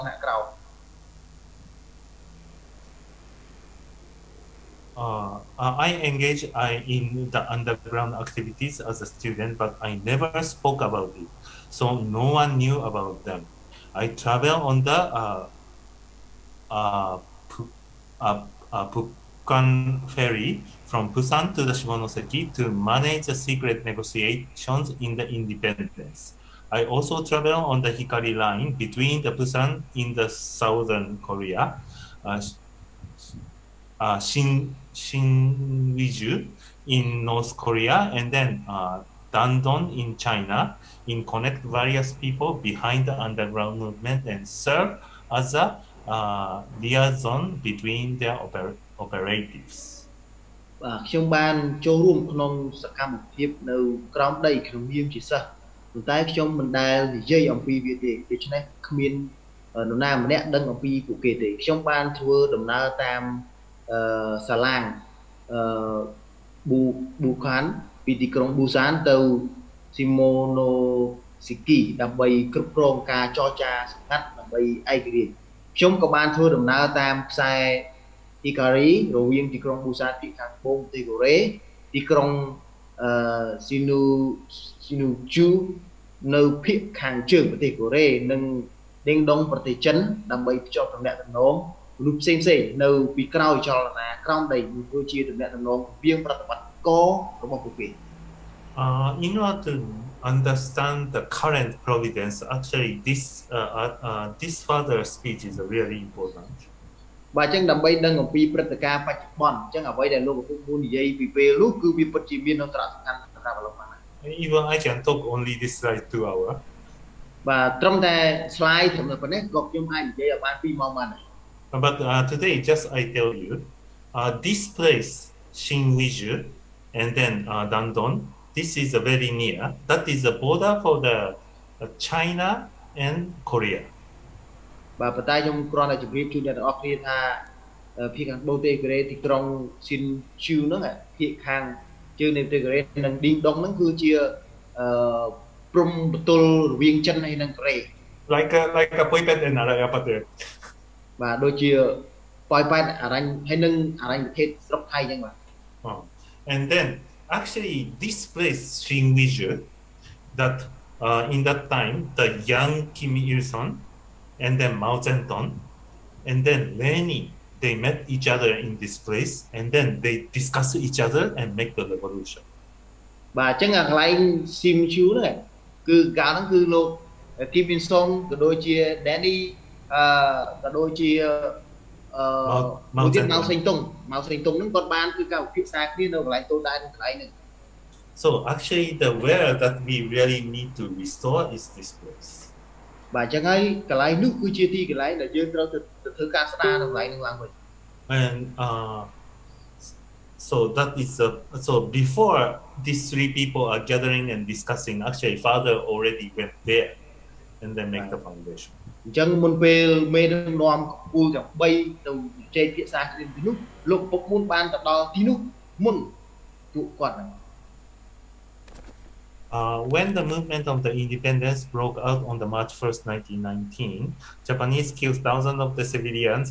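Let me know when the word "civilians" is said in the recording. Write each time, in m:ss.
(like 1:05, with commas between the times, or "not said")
3:45.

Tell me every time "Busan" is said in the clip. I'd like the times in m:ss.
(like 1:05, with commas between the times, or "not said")
0:21, 0:29.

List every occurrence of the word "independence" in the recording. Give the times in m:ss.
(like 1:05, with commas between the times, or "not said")
0:25, 3:40.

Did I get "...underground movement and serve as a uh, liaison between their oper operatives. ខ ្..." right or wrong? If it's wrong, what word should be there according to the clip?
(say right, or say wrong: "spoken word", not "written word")
right.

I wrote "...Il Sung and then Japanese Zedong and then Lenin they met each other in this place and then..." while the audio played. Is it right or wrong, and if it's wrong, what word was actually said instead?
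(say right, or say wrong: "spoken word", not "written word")
wrong: "Mao", not "Japanese".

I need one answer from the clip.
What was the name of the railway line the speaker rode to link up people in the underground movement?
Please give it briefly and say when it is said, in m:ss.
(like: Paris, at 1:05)
Hikari line, at 0:27.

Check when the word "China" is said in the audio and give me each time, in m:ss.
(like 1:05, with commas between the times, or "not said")
0:40, 2:11.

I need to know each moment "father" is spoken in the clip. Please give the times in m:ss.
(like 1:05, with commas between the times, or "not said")
3:25.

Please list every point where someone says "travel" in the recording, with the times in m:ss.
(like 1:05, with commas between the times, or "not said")
0:14, 0:27.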